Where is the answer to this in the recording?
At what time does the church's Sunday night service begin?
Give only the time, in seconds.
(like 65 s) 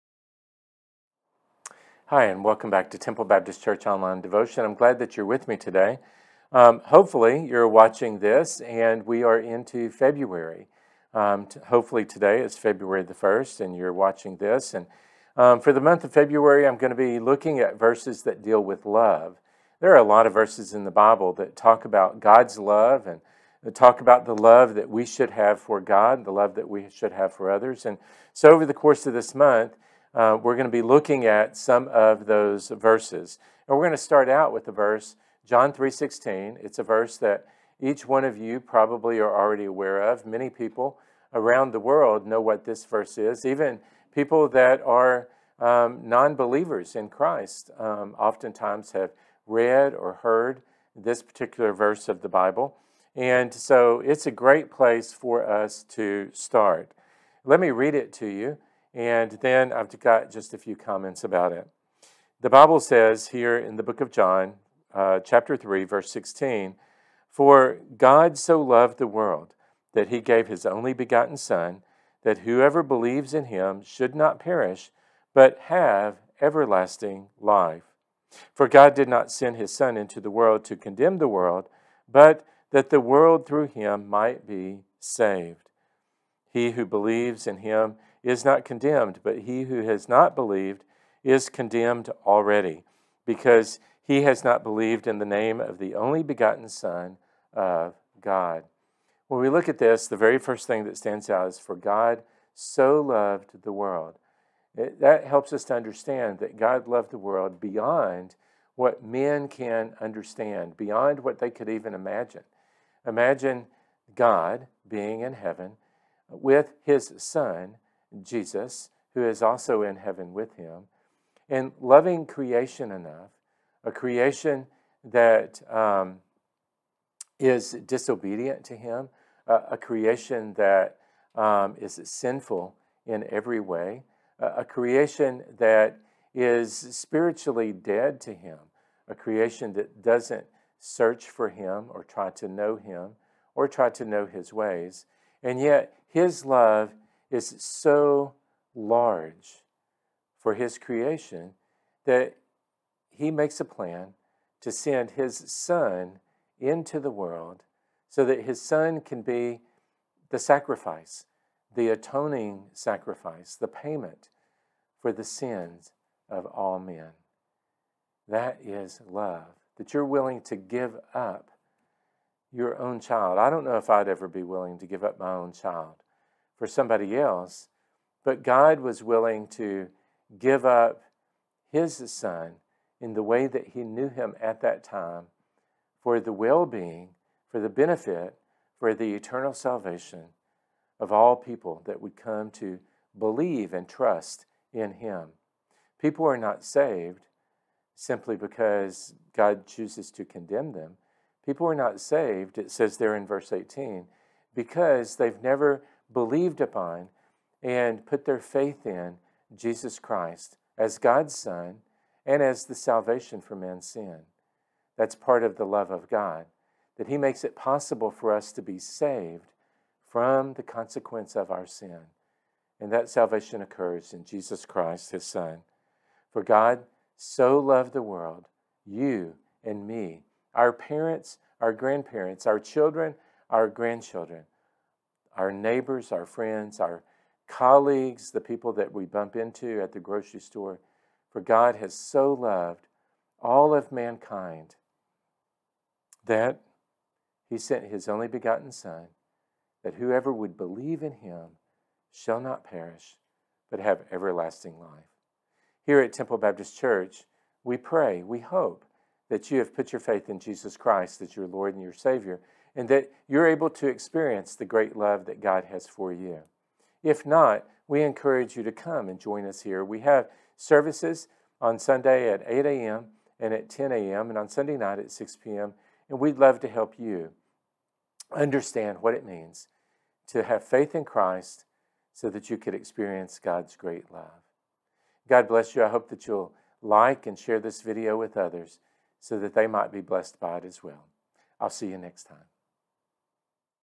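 275 s.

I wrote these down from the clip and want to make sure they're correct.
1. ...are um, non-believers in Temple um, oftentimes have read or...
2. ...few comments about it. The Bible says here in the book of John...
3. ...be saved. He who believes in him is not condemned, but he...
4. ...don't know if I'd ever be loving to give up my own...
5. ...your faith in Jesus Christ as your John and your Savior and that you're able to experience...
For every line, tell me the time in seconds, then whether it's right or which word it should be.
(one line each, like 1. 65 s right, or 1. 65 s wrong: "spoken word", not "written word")
1. 44 s wrong: "Christ", not "Temple"
2. 60 s right
3. 84 s right
4. 173 s wrong: "willing", not "loving"
5. 259 s wrong: "Lord", not "John".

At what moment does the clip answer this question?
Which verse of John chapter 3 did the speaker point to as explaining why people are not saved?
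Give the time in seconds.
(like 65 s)
203 s.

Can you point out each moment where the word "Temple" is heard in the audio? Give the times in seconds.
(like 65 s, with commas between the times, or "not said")
2 s, 256 s.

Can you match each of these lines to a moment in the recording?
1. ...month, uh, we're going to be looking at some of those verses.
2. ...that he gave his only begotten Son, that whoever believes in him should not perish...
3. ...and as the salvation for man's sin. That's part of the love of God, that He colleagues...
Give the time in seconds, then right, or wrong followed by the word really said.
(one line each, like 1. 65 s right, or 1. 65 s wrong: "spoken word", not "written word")
1. 29 s right
2. 69 s right
3. 212 s wrong: "makes", not "colleagues".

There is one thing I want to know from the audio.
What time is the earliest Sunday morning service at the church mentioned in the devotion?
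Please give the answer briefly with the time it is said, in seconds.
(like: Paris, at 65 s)
8 a.m., at 272 s.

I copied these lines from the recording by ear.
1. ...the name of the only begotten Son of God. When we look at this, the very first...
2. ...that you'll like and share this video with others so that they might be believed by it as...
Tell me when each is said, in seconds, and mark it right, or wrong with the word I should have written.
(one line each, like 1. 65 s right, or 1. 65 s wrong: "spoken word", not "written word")
1. 95 s right
2. 286 s wrong: "blessed", not "believed".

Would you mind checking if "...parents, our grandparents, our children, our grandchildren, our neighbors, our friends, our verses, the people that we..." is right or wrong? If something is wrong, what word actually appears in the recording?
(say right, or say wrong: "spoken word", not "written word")
wrong: "colleagues", not "verses".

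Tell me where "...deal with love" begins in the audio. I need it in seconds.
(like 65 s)
18 s.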